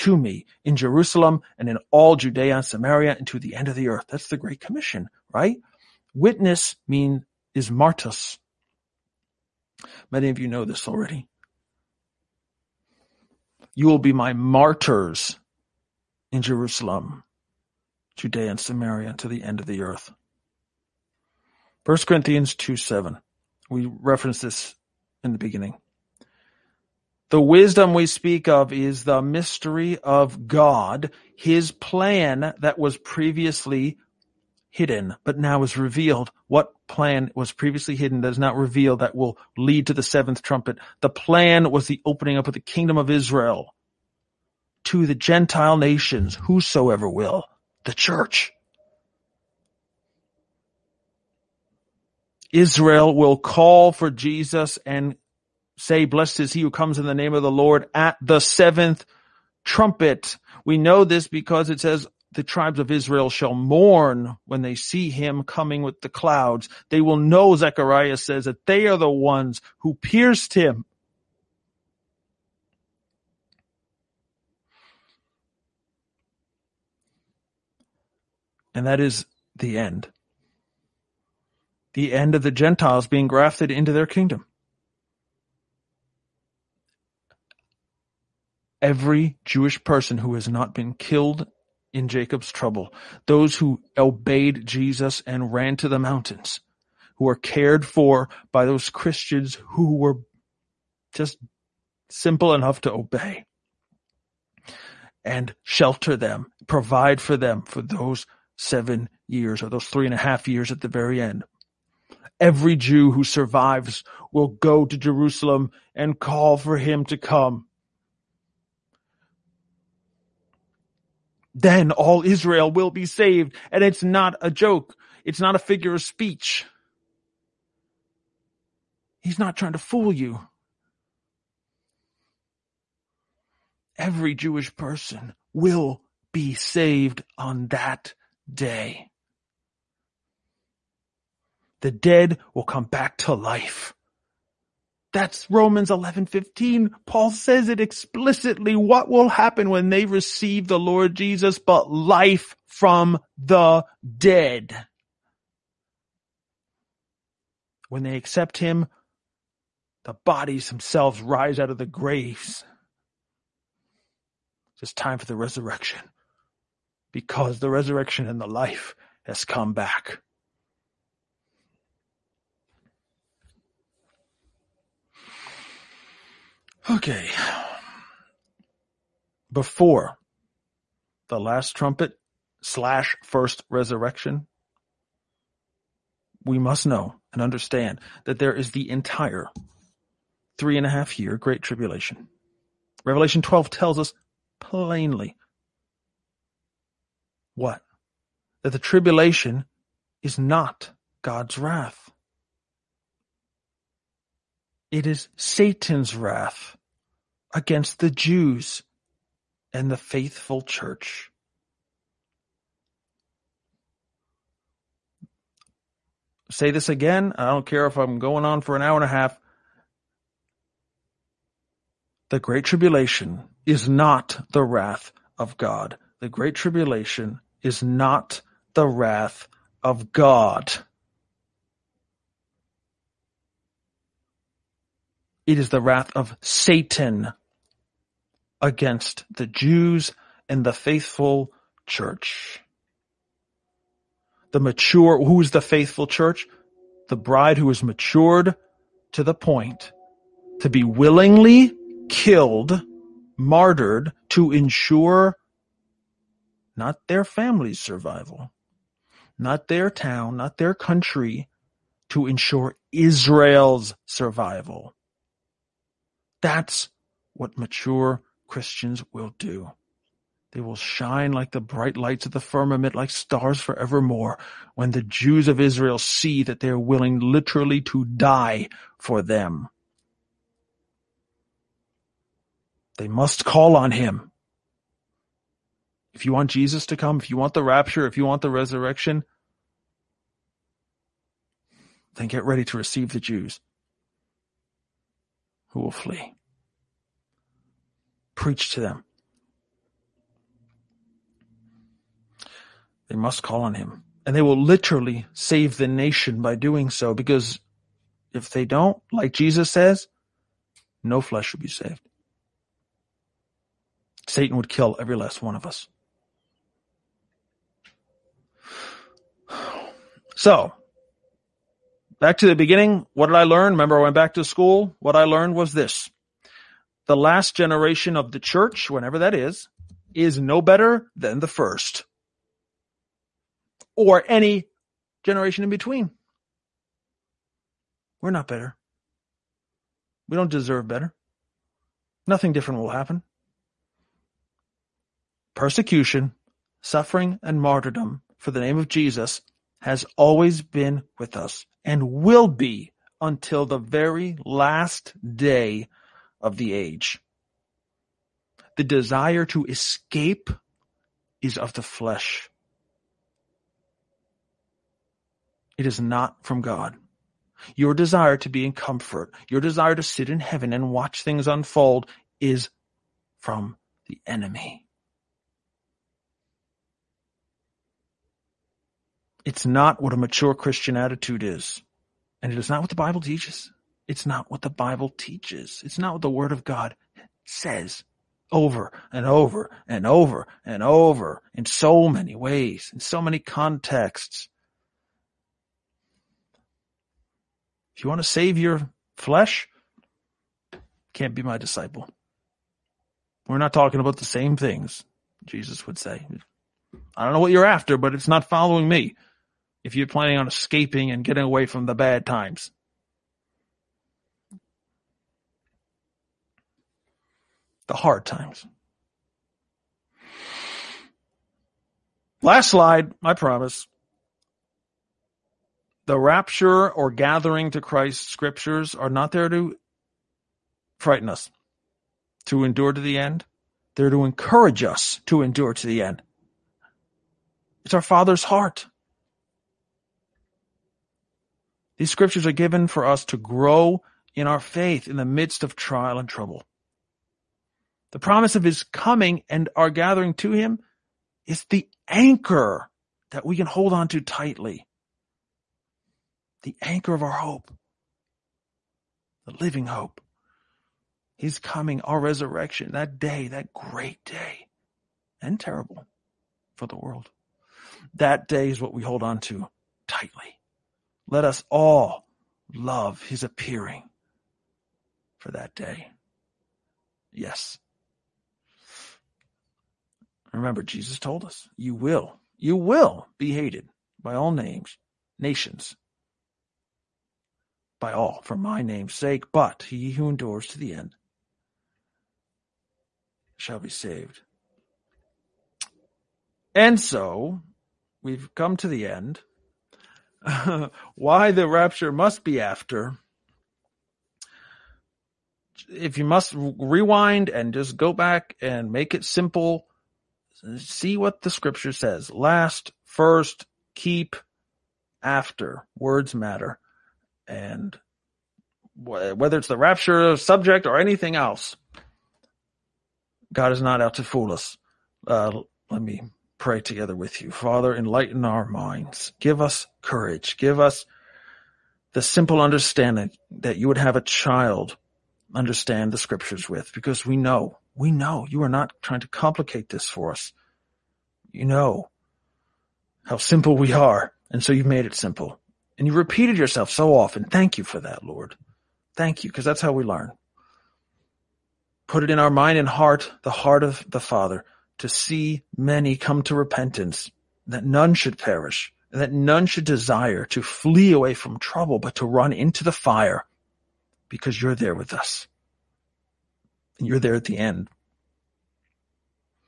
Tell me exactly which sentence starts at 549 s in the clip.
Thank you because that's how we learn.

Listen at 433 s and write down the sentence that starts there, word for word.
They're to encourage us to endure to the end.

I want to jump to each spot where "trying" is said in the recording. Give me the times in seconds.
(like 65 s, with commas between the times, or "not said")
129 s, 539 s.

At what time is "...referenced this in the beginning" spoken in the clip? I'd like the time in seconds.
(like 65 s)
23 s.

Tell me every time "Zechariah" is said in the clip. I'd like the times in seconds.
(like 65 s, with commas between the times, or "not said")
67 s.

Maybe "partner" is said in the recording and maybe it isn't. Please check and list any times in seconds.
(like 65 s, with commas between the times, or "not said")
not said.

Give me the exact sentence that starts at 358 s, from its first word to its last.
The desire to escape is of the flesh.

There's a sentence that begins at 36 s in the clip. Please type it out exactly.
What plan was previously hidden that is now revealed that will lead to the seventh trumpet?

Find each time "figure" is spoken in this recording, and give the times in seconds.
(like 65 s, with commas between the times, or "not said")
125 s.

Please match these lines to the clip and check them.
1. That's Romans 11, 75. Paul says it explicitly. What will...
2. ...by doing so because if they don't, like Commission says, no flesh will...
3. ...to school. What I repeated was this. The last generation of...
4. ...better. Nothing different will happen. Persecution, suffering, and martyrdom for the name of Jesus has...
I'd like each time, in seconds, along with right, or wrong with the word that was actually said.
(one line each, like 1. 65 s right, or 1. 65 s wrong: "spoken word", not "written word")
1. 145 s wrong: "15", not "75"
2. 306 s wrong: "Jesus", not "Commission"
3. 324 s wrong: "learned", not "repeated"
4. 340 s right.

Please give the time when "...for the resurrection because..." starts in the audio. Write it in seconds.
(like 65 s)
165 s.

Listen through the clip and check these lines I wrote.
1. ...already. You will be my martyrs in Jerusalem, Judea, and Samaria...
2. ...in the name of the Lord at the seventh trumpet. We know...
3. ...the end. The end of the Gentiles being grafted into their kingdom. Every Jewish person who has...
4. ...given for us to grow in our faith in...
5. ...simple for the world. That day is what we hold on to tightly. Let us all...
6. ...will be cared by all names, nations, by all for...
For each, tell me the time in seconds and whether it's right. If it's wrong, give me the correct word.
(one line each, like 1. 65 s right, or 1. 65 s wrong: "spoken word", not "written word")
1. 10 s right
2. 56 s right
3. 79 s right
4. 442 s right
5. 465 s wrong: "terrible", not "simple"
6. 482 s wrong: "hated", not "cared".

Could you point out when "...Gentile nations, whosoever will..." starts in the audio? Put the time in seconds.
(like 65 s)
45 s.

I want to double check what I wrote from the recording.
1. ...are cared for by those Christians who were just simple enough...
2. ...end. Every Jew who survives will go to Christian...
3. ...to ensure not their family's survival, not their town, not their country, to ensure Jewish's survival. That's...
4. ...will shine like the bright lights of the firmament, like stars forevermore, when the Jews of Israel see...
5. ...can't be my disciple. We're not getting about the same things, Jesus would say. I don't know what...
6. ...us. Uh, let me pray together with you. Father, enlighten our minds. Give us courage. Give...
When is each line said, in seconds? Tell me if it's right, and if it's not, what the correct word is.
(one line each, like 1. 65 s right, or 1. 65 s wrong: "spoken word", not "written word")
1. 97 s right
2. 111 s wrong: "Jerusalem", not "Christian"
3. 254 s wrong: "Israel", not "Jewish"
4. 270 s right
5. 401 s wrong: "talking", not "getting"
6. 524 s right.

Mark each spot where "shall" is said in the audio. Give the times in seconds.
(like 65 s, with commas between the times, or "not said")
63 s, 493 s.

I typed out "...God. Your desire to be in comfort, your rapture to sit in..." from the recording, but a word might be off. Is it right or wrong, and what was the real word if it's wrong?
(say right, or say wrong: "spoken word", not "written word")
wrong: "desire", not "rapture".